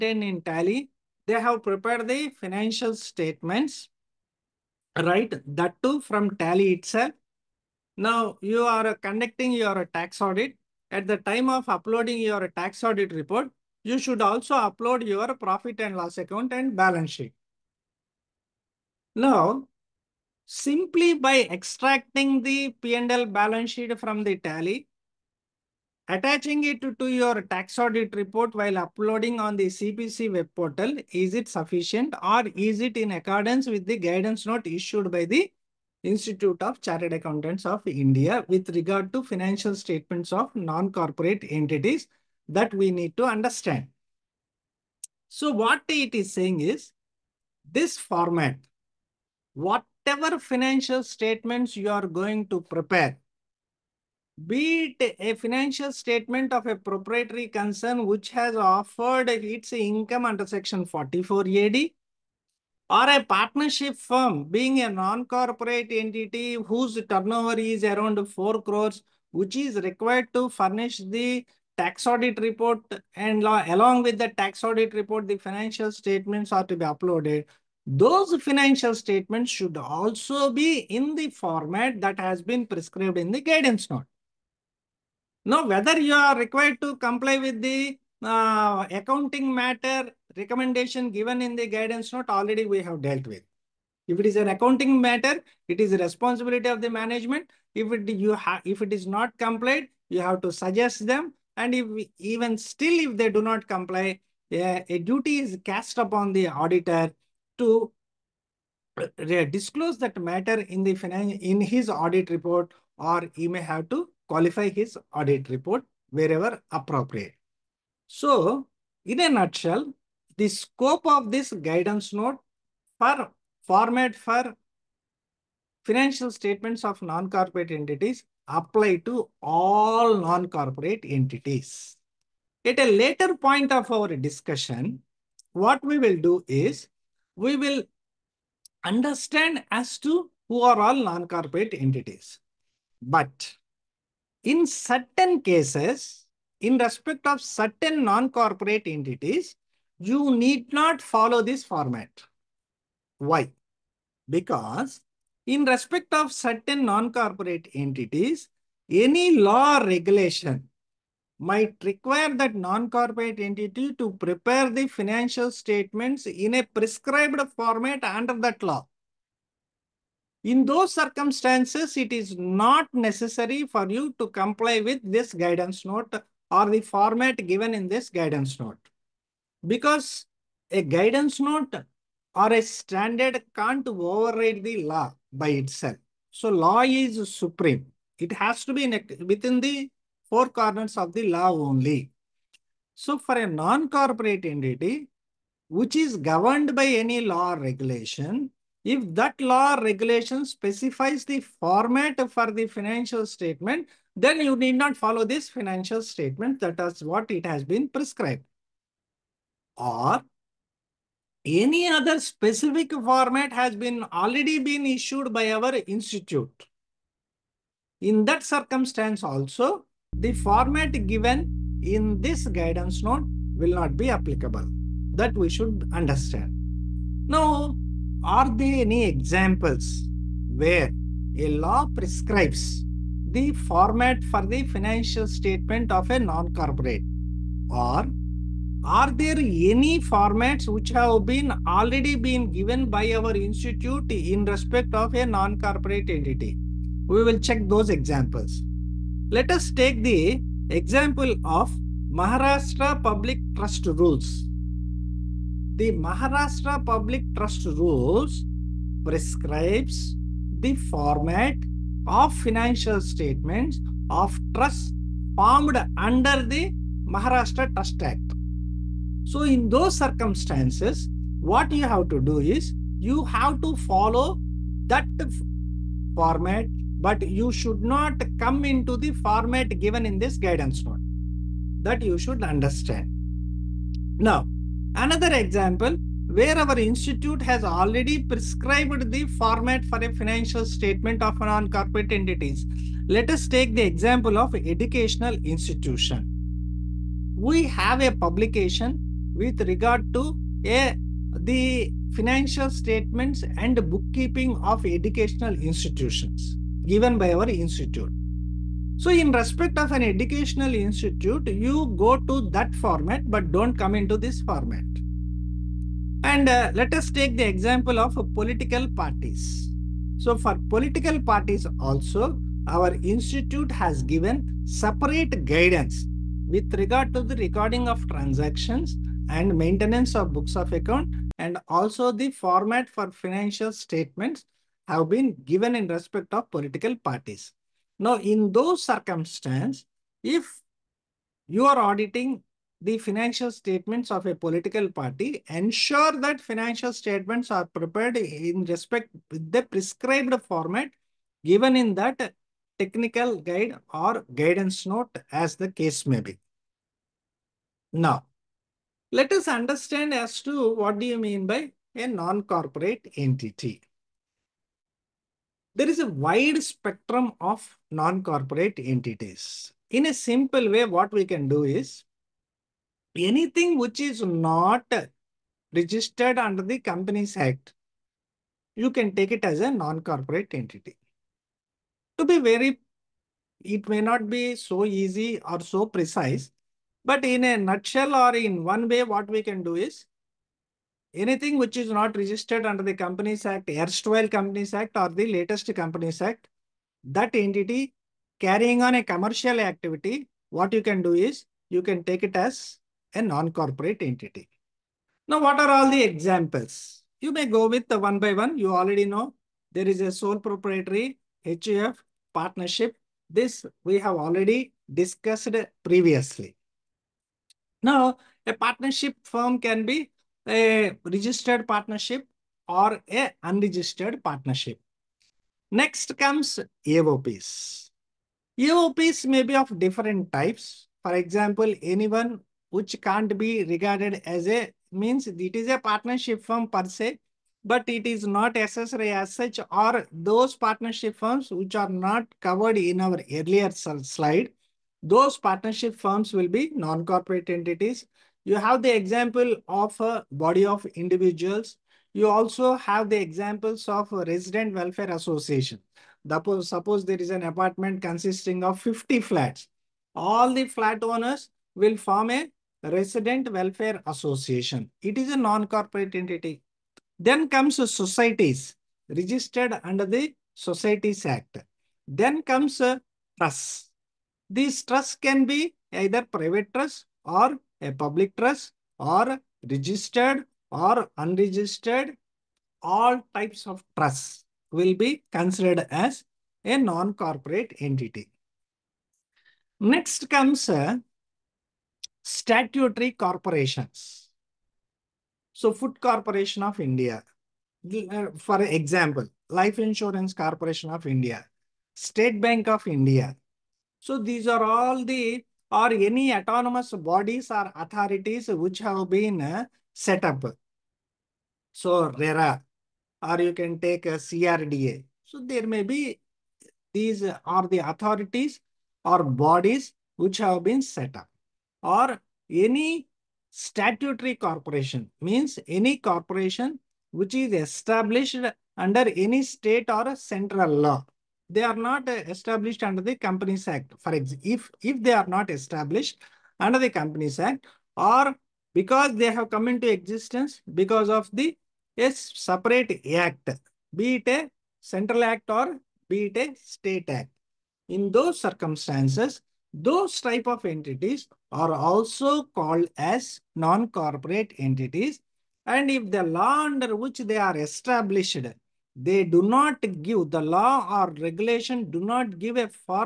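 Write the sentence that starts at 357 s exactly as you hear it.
Now, let us understand as to what do you mean by a non-corporate entity there is a wide spectrum of non-corporate entities.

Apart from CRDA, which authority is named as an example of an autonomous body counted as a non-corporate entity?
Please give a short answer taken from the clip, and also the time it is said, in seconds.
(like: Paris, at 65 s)
RERA, at 512 s.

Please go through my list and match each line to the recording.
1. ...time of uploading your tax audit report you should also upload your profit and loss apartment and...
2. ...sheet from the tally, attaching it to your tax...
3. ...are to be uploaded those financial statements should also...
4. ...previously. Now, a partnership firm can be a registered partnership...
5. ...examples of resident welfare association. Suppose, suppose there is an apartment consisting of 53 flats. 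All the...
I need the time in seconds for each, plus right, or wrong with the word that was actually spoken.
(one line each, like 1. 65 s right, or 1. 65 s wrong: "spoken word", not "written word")
1. 11 s wrong: "account", not "apartment"
2. 23 s right
3. 76 s right
4. 415 s right
5. 453 s wrong: "50", not "53".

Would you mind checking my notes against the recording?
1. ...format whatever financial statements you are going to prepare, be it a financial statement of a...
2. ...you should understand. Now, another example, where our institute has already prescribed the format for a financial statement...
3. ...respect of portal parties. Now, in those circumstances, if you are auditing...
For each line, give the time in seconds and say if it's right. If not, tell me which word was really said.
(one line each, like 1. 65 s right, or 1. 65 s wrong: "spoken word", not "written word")
1. 47 s right
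2. 282 s right
3. 335 s wrong: "political", not "portal".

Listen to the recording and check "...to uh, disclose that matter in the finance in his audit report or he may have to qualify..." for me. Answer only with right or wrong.
right.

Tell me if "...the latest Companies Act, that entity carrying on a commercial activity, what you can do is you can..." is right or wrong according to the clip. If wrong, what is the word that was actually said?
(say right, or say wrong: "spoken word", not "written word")
right.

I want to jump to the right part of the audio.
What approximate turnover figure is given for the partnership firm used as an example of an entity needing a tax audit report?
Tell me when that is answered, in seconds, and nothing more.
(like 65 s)
68 s.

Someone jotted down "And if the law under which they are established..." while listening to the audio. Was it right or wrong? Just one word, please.
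right.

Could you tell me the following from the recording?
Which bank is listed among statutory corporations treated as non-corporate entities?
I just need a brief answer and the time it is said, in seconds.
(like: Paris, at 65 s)
State Bank of India, at 501 s.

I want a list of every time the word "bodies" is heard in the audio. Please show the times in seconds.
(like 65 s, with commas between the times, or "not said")
507 s, 519 s.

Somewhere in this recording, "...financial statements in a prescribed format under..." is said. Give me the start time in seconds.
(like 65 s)
164 s.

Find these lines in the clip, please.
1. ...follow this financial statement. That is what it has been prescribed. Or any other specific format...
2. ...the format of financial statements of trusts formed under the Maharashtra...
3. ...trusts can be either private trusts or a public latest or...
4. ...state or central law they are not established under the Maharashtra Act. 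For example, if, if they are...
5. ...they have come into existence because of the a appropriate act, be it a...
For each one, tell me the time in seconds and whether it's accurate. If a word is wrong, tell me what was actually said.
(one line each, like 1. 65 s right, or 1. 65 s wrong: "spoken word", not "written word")
1. 204 s right
2. 260 s right
3. 474 s wrong: "trust", not "latest"
4. 529 s wrong: "Companies", not "Maharashtra"
5. 539 s wrong: "separate", not "appropriate".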